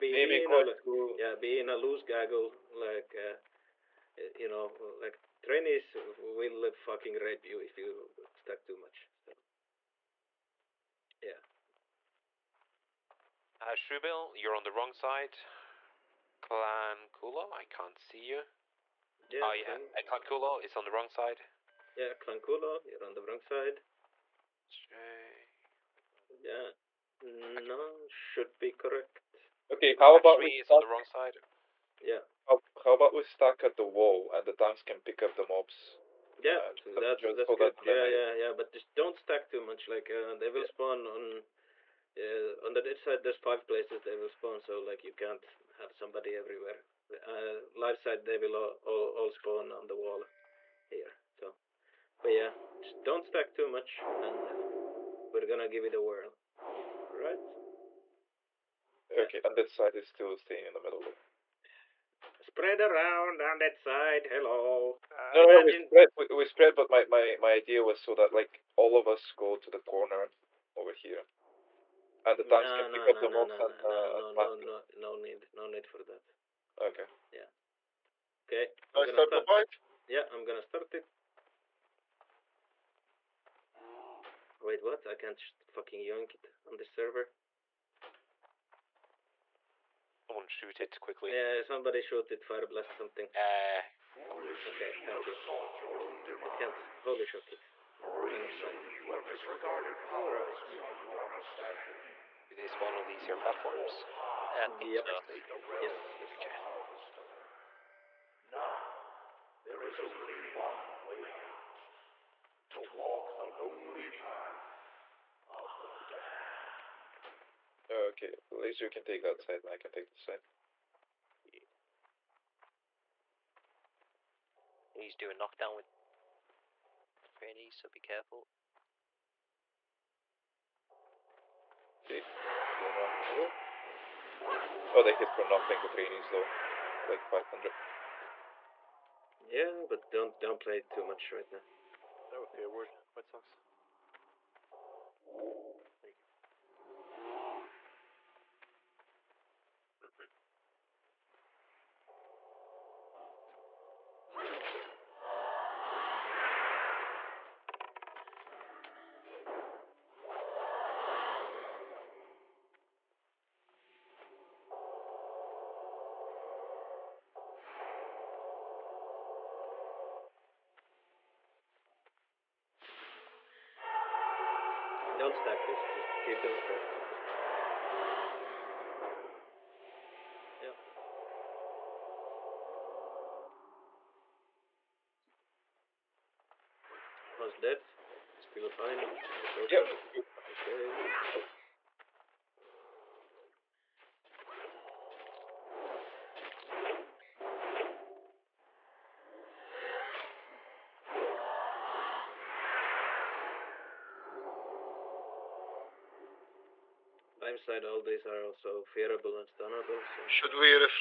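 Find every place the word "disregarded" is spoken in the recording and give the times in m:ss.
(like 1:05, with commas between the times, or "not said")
1:39.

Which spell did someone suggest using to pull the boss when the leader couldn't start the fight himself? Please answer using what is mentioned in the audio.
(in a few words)
Fire blast.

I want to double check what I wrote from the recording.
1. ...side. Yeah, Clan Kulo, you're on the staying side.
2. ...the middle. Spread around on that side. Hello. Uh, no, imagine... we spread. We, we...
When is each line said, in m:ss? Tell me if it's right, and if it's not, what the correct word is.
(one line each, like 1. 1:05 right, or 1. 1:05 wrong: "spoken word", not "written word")
1. 0:21 wrong: "wrong", not "staying"
2. 1:00 right.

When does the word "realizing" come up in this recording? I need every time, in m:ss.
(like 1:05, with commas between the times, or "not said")
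not said.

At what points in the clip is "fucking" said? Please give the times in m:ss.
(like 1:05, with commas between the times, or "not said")
0:06, 1:25.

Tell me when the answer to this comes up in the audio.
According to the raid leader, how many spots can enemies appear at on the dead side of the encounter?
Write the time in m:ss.
0:43.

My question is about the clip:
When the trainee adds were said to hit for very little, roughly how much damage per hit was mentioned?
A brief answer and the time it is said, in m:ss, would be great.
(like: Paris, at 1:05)
500, at 2:17.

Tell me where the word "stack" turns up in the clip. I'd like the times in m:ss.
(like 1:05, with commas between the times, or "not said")
0:08, 0:33, 0:39, 0:53, 2:55.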